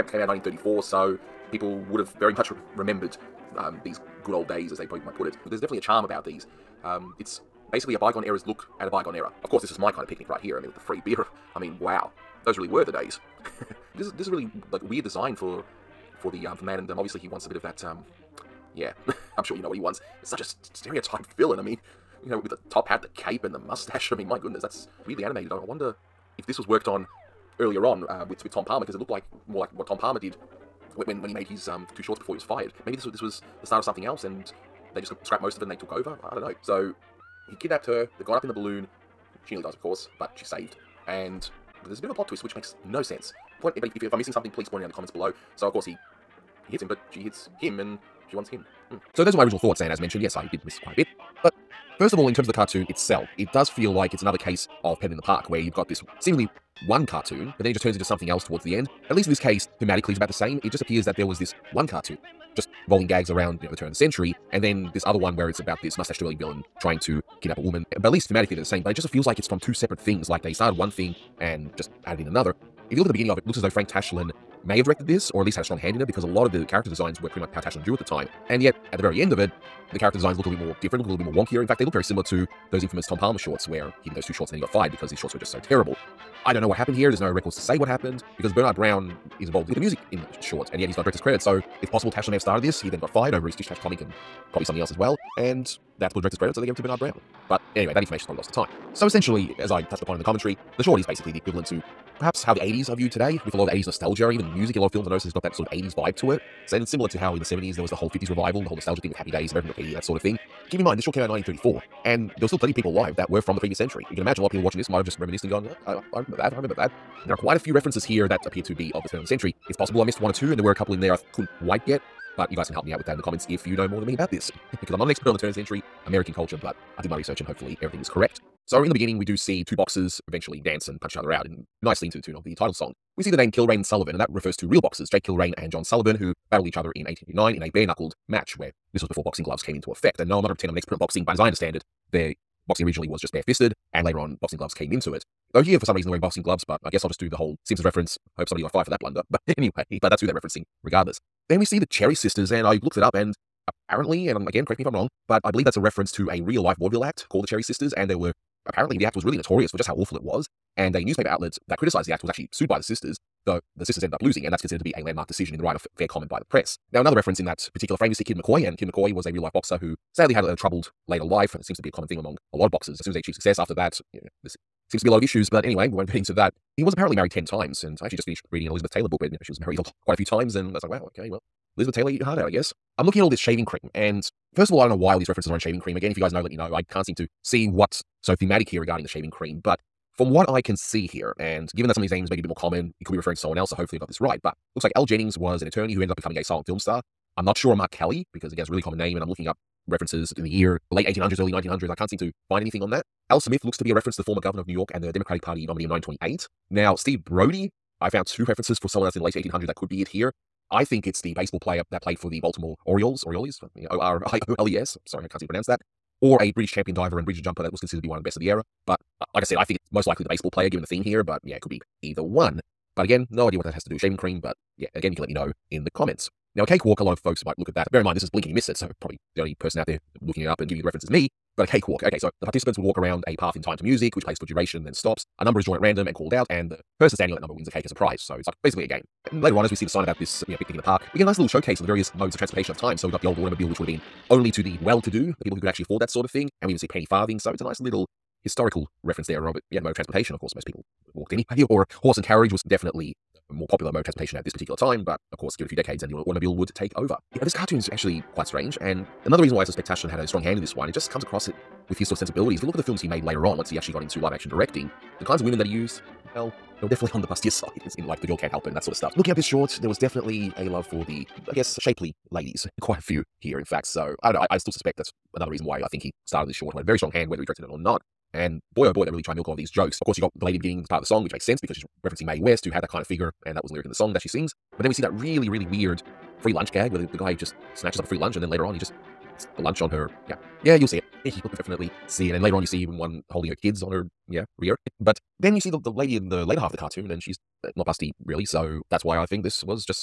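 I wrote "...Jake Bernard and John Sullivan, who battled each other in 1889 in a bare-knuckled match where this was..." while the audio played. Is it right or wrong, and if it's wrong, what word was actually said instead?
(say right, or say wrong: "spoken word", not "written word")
wrong: "Kilrain", not "Bernard".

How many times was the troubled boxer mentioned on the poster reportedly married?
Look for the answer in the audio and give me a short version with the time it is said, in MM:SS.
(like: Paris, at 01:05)
10, at 02:57.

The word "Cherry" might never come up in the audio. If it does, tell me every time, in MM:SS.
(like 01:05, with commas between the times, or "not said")
02:31, 02:37.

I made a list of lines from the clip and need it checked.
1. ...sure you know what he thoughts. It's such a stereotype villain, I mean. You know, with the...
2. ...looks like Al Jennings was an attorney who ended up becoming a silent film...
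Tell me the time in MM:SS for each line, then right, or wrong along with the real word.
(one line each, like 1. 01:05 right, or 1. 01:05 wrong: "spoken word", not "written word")
1. 00:19 wrong: "wants", not "thoughts"
2. 03:14 right.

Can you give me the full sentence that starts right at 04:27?
It's in like the girl can't help it and that sort of stuff.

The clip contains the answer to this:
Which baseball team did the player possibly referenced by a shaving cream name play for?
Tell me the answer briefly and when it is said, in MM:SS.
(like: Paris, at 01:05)
Baltimore Orioles, at 03:32.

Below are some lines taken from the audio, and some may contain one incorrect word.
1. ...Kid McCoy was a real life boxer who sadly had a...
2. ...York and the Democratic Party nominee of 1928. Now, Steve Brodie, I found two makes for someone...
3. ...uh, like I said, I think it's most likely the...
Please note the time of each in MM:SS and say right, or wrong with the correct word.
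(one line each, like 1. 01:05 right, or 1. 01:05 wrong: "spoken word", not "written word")
1. 02:48 right
2. 03:24 wrong: "references", not "makes"
3. 03:39 right.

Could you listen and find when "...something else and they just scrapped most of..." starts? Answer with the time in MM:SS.
00:33.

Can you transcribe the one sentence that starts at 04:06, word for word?
And we even see penny farthing.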